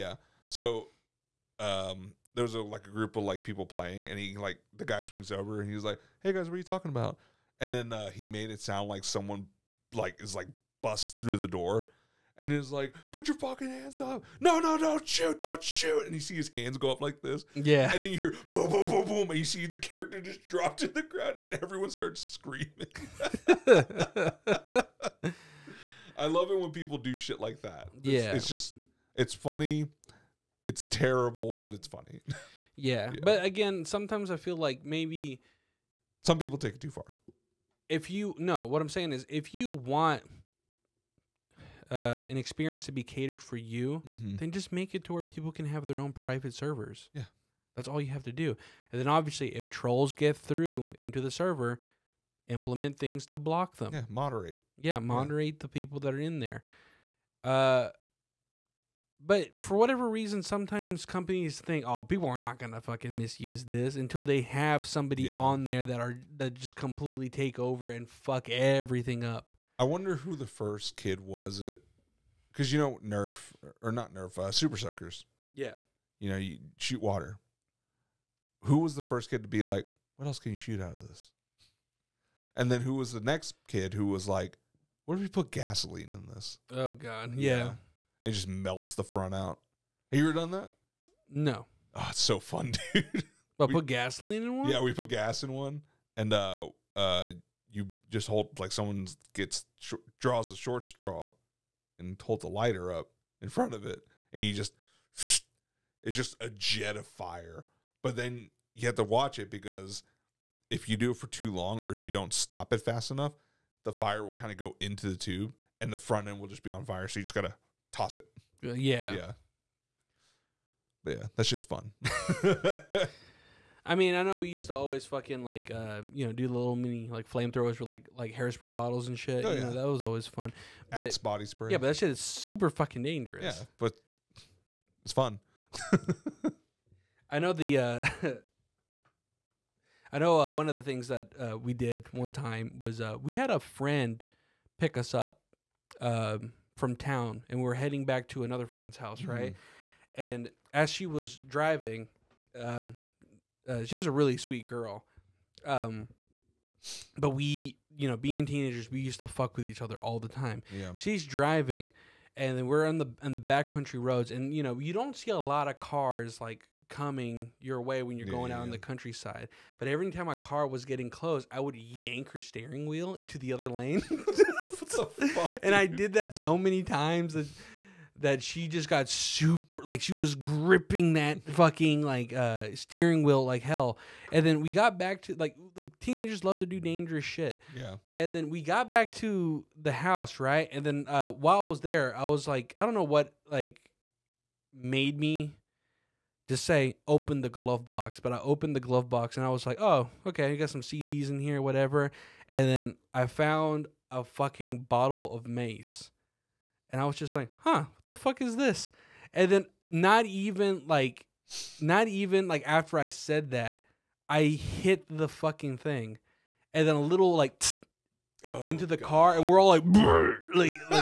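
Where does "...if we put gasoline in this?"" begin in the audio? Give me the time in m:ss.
1:25.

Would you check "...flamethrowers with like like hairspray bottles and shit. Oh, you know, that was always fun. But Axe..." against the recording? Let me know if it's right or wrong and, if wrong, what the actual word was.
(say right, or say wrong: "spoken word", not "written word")
right.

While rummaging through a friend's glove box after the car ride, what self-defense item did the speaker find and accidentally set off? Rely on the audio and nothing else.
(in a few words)
mace.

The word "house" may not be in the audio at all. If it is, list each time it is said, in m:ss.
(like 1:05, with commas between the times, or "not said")
2:28, 3:09.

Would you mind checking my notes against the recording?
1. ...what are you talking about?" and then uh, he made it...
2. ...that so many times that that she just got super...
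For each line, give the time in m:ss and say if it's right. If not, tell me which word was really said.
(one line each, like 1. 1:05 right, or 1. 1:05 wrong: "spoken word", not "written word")
1. 0:06 right
2. 2:56 right.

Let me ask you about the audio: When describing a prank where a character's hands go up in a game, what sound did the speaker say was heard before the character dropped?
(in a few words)
boom, boom, boom, boom.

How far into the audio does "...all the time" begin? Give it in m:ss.
2:39.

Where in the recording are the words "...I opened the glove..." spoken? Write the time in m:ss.
3:18.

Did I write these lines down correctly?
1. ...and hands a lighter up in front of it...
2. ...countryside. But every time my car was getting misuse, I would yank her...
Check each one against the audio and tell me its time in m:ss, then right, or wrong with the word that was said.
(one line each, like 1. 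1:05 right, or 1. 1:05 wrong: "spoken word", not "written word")
1. 1:41 wrong: "holds", not "hands"
2. 2:48 wrong: "close", not "misuse".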